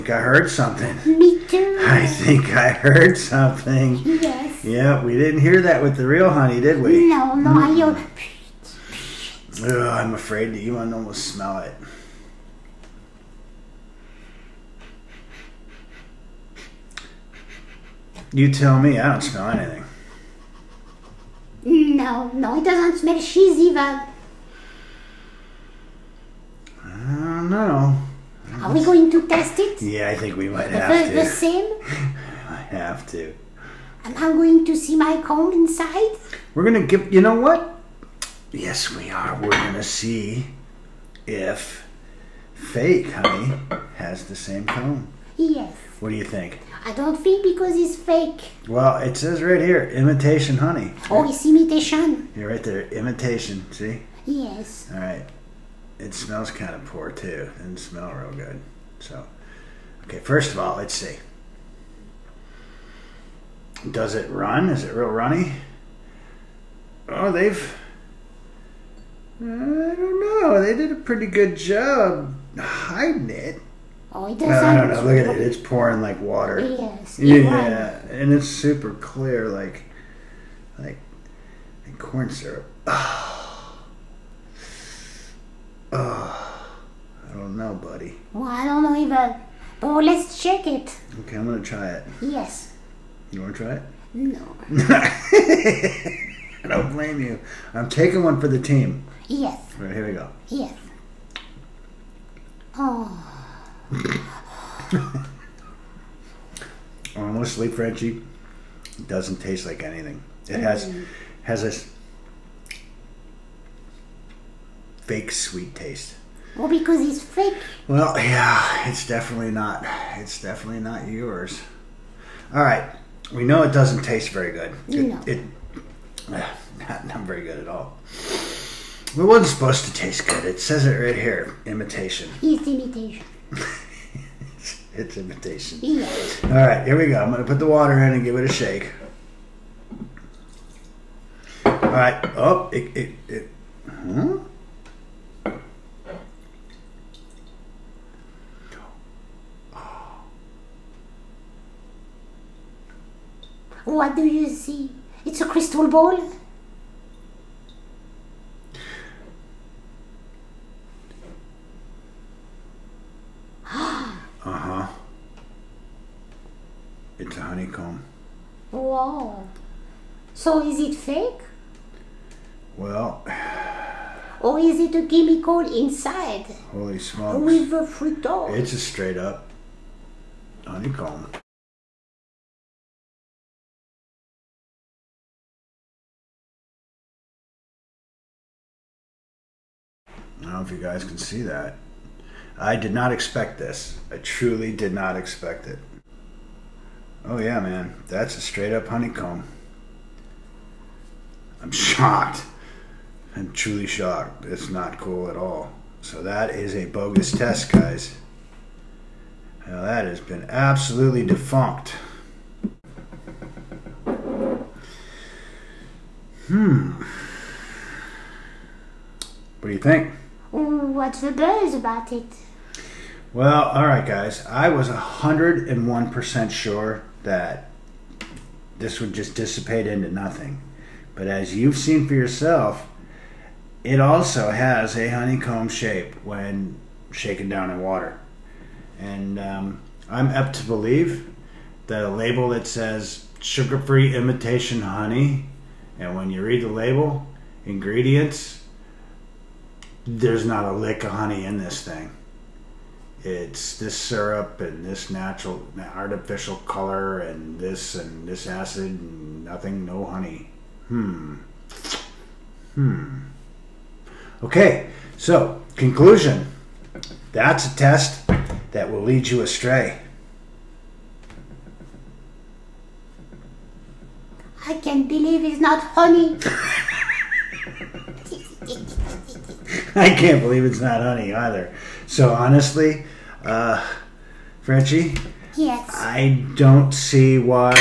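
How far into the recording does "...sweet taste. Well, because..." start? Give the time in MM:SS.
01:55.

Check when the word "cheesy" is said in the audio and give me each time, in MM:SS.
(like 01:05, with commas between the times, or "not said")
00:23.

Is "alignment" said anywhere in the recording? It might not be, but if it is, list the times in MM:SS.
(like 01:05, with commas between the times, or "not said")
not said.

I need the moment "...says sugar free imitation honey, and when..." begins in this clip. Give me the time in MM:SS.
04:02.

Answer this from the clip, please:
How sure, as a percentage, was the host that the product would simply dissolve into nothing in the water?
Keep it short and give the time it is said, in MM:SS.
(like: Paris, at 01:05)
101%, at 03:44.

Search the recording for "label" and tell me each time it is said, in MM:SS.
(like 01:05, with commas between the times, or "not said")
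04:02, 04:06.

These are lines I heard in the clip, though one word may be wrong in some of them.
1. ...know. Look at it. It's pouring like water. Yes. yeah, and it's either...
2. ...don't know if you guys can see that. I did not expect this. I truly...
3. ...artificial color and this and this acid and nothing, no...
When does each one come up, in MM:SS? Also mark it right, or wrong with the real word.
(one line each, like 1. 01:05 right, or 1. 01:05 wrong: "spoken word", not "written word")
1. 01:14 wrong: "super", not "either"
2. 03:10 right
3. 04:15 right.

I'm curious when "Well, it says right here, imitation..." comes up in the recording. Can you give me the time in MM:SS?
00:48.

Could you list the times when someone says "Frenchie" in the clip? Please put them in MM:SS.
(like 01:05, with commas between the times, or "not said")
01:47, 04:44.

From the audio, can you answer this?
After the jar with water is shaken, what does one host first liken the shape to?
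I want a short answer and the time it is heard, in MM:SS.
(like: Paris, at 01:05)
A crystal ball, at 02:35.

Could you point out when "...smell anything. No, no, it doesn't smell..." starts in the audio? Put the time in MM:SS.
00:19.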